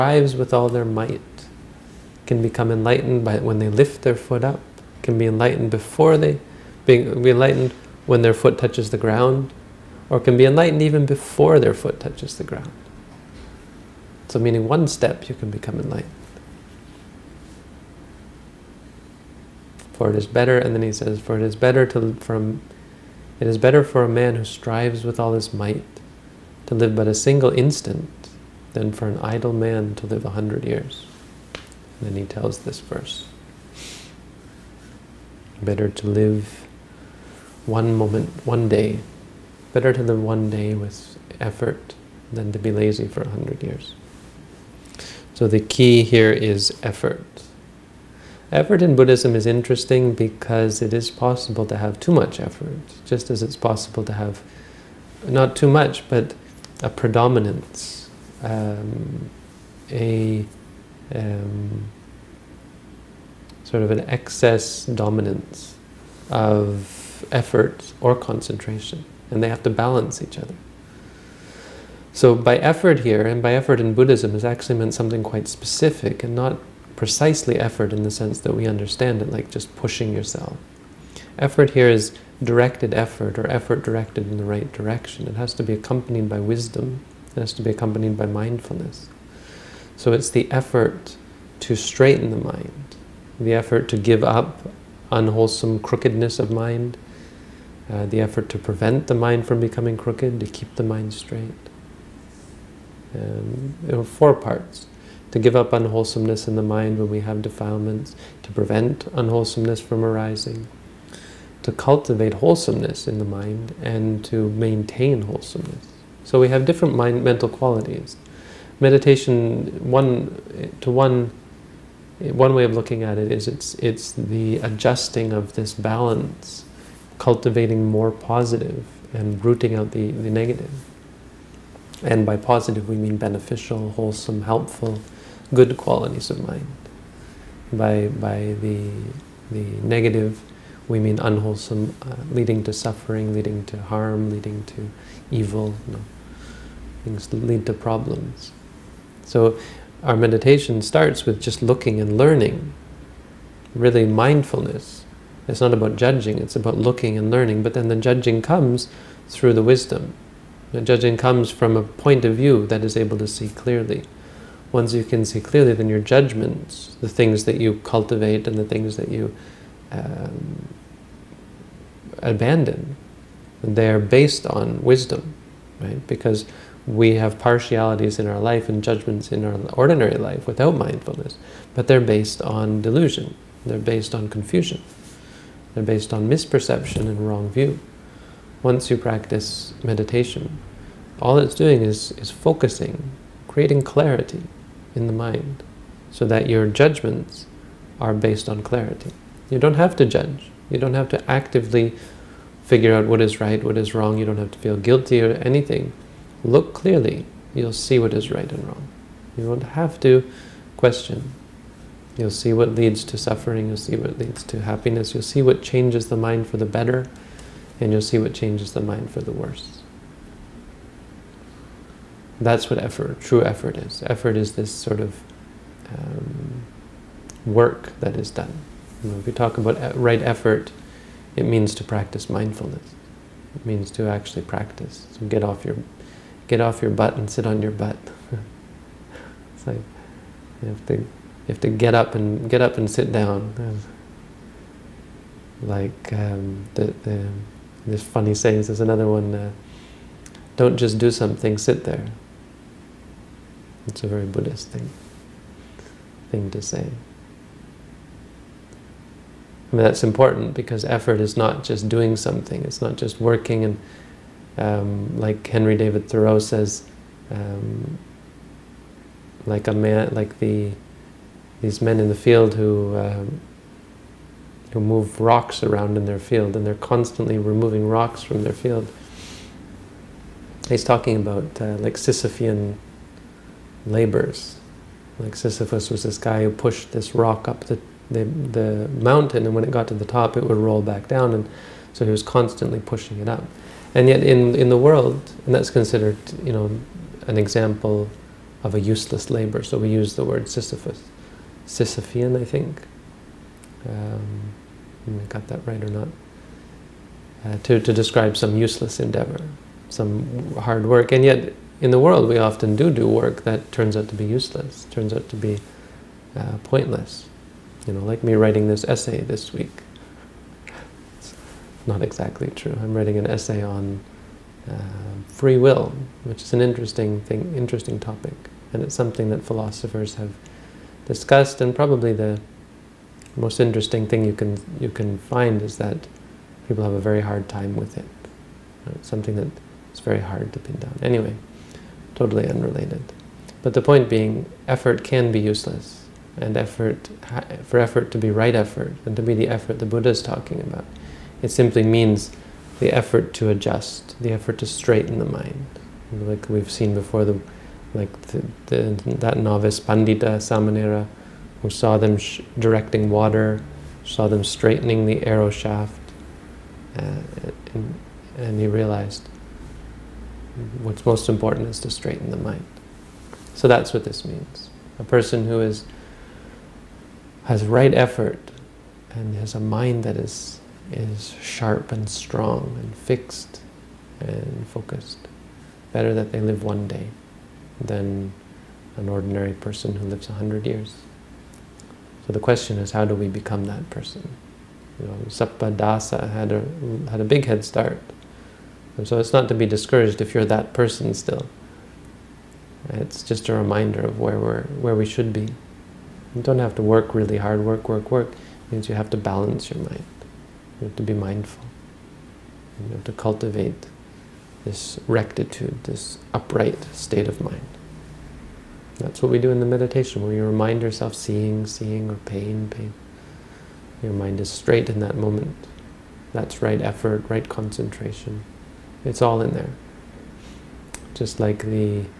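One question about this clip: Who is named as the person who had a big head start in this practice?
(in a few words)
Sappadasa.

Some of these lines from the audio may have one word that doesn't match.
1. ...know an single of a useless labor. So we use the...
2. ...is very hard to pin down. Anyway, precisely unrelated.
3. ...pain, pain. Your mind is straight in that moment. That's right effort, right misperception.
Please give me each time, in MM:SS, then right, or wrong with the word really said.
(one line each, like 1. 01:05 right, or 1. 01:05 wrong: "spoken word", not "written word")
1. 04:56 wrong: "example", not "single"
2. 05:39 wrong: "totally", not "precisely"
3. 07:02 wrong: "concentration", not "misperception".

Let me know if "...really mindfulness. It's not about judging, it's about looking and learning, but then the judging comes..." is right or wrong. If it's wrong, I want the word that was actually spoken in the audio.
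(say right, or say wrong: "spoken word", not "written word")
right.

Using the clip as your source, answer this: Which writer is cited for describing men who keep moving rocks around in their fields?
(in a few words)
Henry David Thoreau.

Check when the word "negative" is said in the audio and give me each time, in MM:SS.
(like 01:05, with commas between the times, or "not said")
02:10, 02:19.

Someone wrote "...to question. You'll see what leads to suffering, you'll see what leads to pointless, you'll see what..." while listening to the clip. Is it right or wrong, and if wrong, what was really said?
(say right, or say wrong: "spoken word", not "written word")
wrong: "happiness", not "pointless".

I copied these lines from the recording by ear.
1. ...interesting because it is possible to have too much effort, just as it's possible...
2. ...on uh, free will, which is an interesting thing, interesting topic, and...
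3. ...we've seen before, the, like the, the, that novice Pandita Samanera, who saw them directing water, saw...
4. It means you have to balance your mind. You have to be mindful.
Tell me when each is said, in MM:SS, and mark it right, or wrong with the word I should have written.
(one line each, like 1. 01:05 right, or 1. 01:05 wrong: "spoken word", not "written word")
1. 00:49 right
2. 05:23 right
3. 05:56 right
4. 06:48 right.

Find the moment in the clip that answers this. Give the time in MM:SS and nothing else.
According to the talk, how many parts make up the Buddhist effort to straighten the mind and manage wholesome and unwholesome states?
01:44.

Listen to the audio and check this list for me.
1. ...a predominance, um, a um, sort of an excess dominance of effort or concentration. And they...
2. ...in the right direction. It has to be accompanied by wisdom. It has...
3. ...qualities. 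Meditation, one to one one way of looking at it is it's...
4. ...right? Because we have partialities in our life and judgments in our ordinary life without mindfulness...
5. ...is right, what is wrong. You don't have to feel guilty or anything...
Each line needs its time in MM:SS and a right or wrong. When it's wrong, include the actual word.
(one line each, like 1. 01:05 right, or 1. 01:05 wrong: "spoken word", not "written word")
1. 00:56 right
2. 01:24 right
3. 01:57 right
4. 02:55 right
5. 03:23 right.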